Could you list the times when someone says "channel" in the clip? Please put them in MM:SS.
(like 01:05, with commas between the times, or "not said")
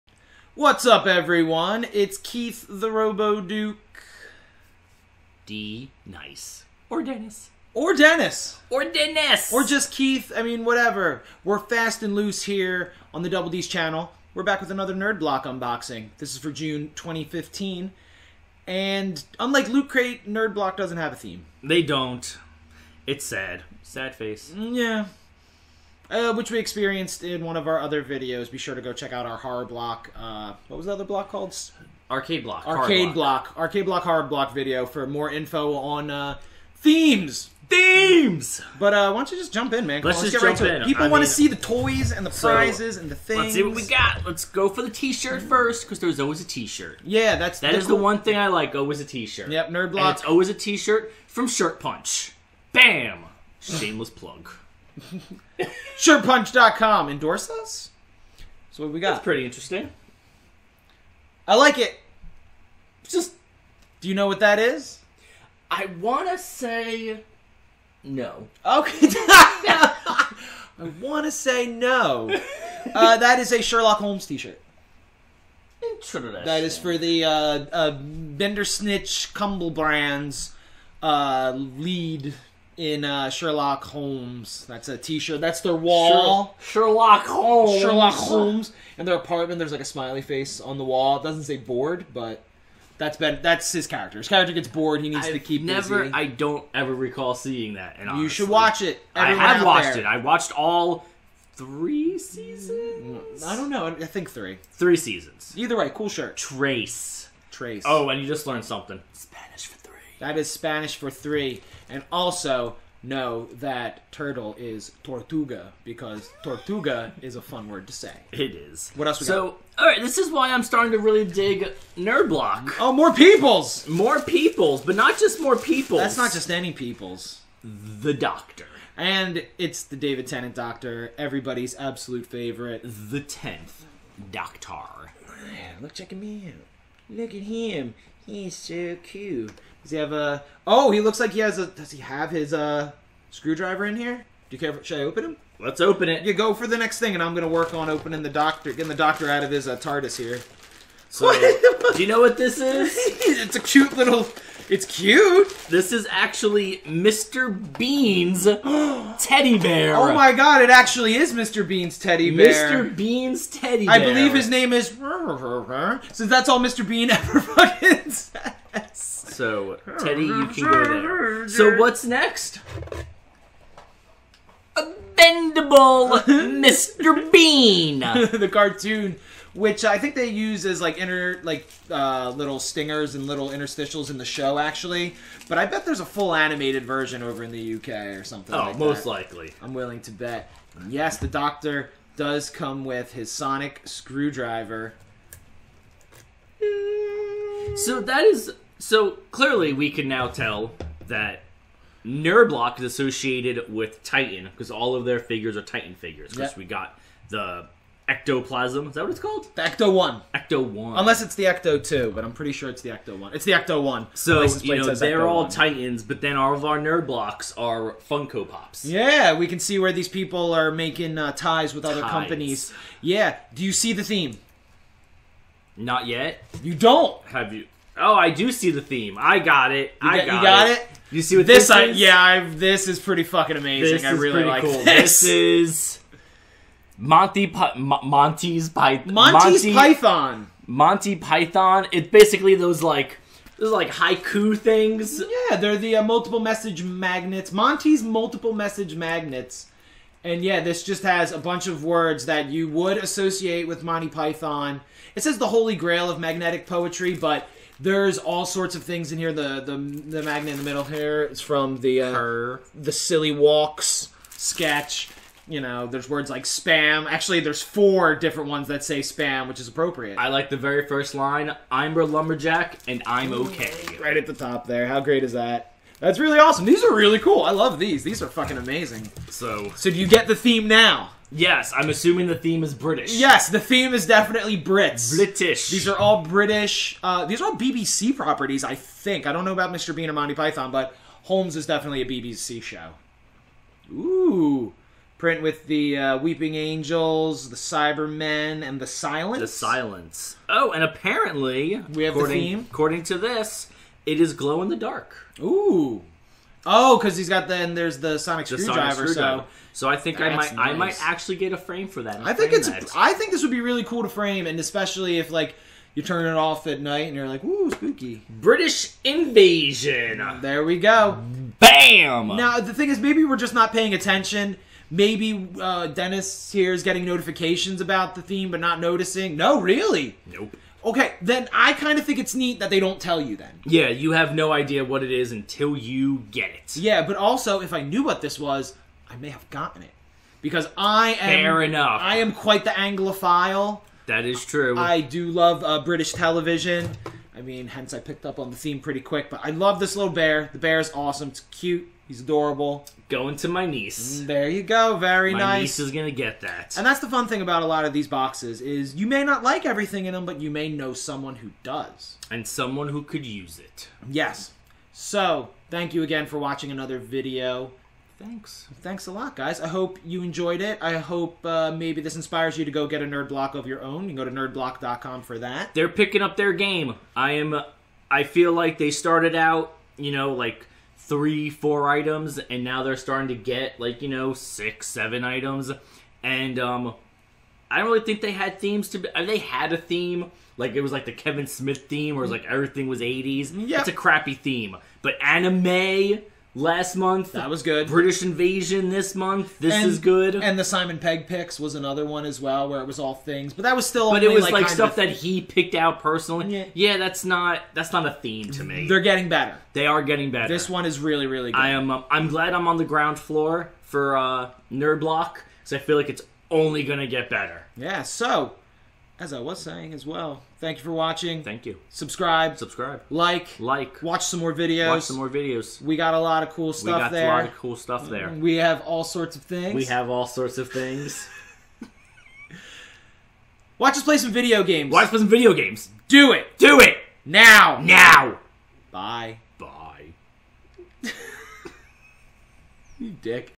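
00:13.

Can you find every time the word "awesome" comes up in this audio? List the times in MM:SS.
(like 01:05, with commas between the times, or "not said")
04:36, 05:50.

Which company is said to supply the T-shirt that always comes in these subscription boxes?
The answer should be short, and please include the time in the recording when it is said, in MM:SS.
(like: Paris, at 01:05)
Shirt Punch, at 00:51.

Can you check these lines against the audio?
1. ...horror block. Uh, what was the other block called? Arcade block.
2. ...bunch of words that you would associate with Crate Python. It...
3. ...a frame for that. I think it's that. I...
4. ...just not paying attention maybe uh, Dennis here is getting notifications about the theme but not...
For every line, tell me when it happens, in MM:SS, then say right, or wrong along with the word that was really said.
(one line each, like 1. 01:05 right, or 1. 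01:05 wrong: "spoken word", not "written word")
1. 00:29 right
2. 04:11 wrong: "Monty", not "Crate"
3. 05:11 right
4. 05:23 right.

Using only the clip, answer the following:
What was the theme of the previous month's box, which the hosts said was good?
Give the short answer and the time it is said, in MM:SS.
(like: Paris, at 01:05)
anime, at 06:35.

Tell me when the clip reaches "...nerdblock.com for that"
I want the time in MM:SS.
06:14.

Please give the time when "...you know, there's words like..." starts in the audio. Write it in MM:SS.
04:25.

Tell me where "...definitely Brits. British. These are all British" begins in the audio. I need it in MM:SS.
04:44.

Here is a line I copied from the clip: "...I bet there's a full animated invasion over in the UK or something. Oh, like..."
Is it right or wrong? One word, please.
wrong.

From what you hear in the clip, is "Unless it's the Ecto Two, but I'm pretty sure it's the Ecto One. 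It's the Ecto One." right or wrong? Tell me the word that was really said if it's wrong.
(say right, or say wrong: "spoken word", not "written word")
right.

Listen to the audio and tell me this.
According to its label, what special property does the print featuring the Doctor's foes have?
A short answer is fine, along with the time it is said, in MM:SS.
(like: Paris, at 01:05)
glow in the dark, at 05:04.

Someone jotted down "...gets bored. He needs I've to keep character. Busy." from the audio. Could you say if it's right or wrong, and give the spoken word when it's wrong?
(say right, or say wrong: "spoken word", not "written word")
wrong: "never", not "character".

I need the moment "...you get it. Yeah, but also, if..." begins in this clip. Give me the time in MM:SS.
05:35.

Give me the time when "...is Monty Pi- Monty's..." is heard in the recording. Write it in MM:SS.
03:55.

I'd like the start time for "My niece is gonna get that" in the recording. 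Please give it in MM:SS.
05:55.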